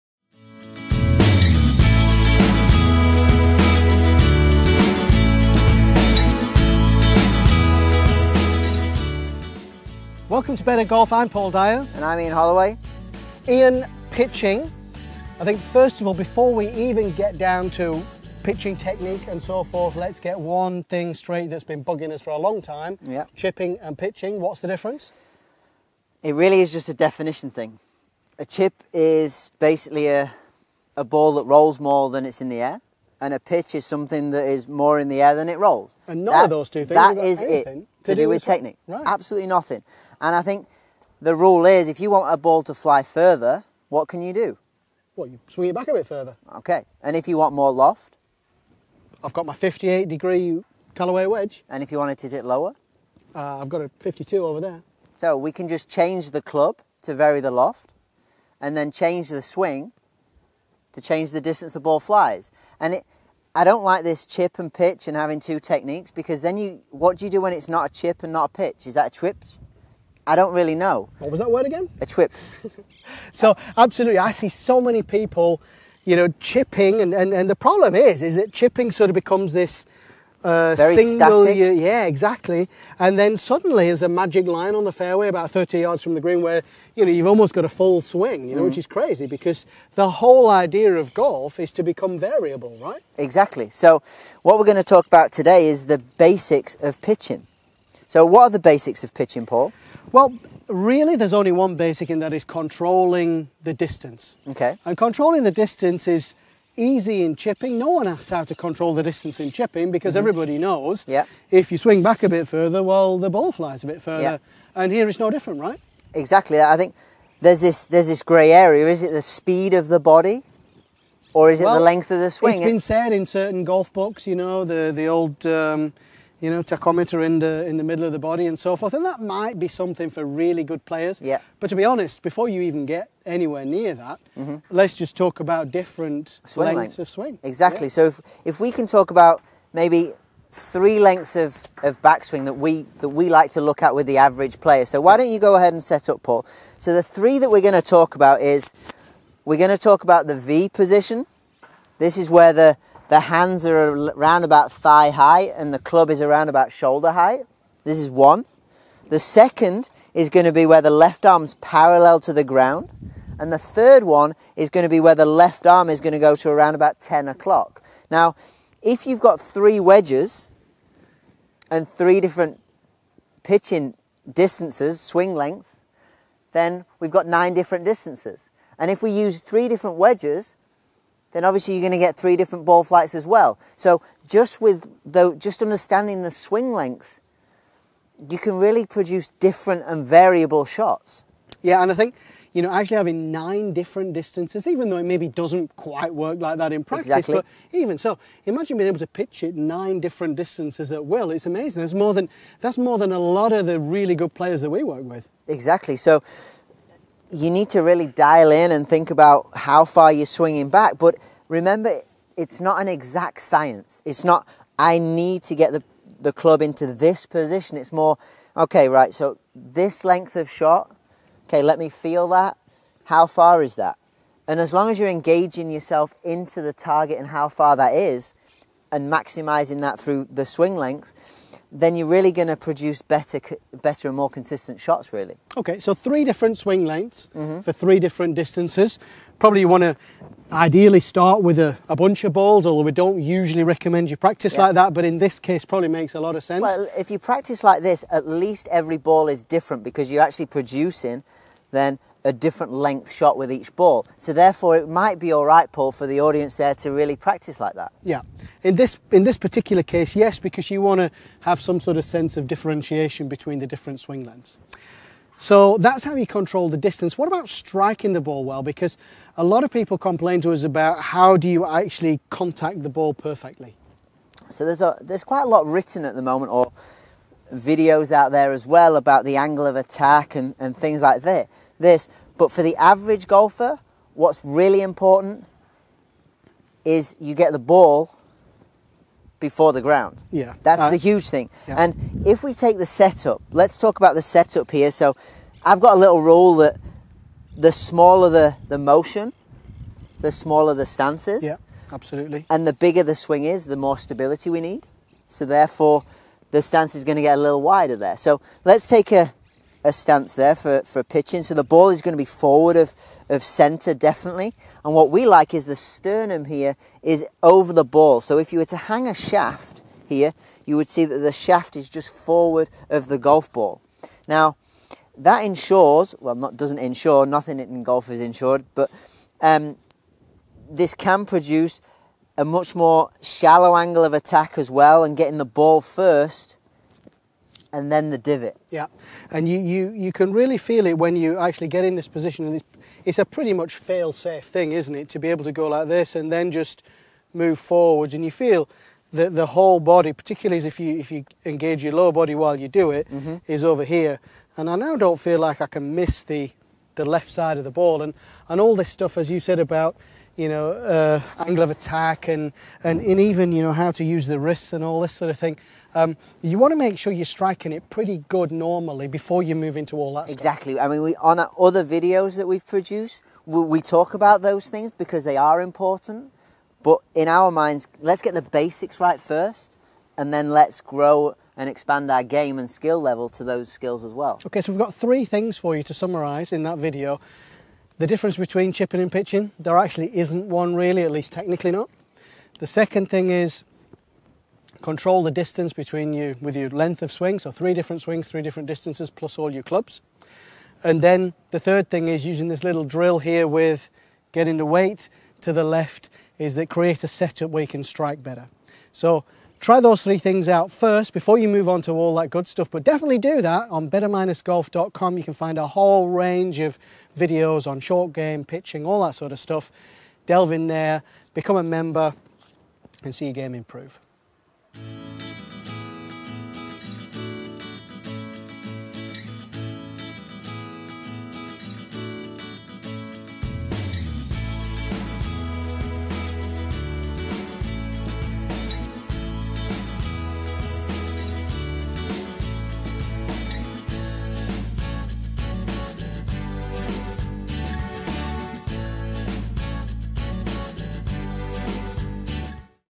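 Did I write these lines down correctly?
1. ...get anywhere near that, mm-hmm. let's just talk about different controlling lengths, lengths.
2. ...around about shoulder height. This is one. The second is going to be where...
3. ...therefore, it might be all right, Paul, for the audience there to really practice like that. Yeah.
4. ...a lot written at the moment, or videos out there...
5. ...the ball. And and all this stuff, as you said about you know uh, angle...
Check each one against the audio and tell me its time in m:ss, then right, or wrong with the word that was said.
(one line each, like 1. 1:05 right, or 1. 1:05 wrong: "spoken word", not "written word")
1. 2:12 wrong: "swing", not "controlling"
2. 2:36 right
3. 4:14 right
4. 4:35 right
5. 5:57 right.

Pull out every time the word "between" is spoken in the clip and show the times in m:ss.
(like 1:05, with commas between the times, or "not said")
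4:23, 6:28, 6:35.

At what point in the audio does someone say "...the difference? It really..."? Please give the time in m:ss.
0:24.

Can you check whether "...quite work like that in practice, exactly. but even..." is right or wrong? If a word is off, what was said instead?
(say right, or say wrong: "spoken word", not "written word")
right.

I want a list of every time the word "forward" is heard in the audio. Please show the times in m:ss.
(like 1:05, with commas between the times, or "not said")
5:12, 5:22, 5:47.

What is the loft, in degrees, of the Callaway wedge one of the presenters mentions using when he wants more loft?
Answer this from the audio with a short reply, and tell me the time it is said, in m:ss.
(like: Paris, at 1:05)
58, at 0:49.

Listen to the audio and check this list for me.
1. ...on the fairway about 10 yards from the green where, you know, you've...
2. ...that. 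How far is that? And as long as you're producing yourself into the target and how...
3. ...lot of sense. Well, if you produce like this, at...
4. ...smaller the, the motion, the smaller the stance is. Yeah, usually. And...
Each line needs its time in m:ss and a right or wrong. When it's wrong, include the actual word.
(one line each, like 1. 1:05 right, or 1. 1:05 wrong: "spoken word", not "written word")
1. 1:24 wrong: "30", not "10"
2. 3:42 wrong: "engaging", not "producing"
3. 4:06 wrong: "practice", not "produce"
4. 4:57 wrong: "absolutely", not "usually".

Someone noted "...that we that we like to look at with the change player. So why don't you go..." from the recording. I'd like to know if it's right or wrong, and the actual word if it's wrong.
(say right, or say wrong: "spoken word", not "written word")
wrong: "average", not "change".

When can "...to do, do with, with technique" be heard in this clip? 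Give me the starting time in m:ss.
0:38.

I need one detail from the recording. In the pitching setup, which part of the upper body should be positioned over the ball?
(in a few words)
Sternum.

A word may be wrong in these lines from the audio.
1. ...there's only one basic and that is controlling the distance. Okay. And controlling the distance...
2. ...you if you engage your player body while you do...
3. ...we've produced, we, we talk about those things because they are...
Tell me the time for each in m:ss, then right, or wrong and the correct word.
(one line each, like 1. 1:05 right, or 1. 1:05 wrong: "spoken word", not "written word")
1. 1:41 right
2. 5:50 wrong: "lower", not "player"
3. 6:12 right.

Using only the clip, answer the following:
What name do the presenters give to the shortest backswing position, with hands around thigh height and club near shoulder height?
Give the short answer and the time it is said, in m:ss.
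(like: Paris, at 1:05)
V position, at 2:30.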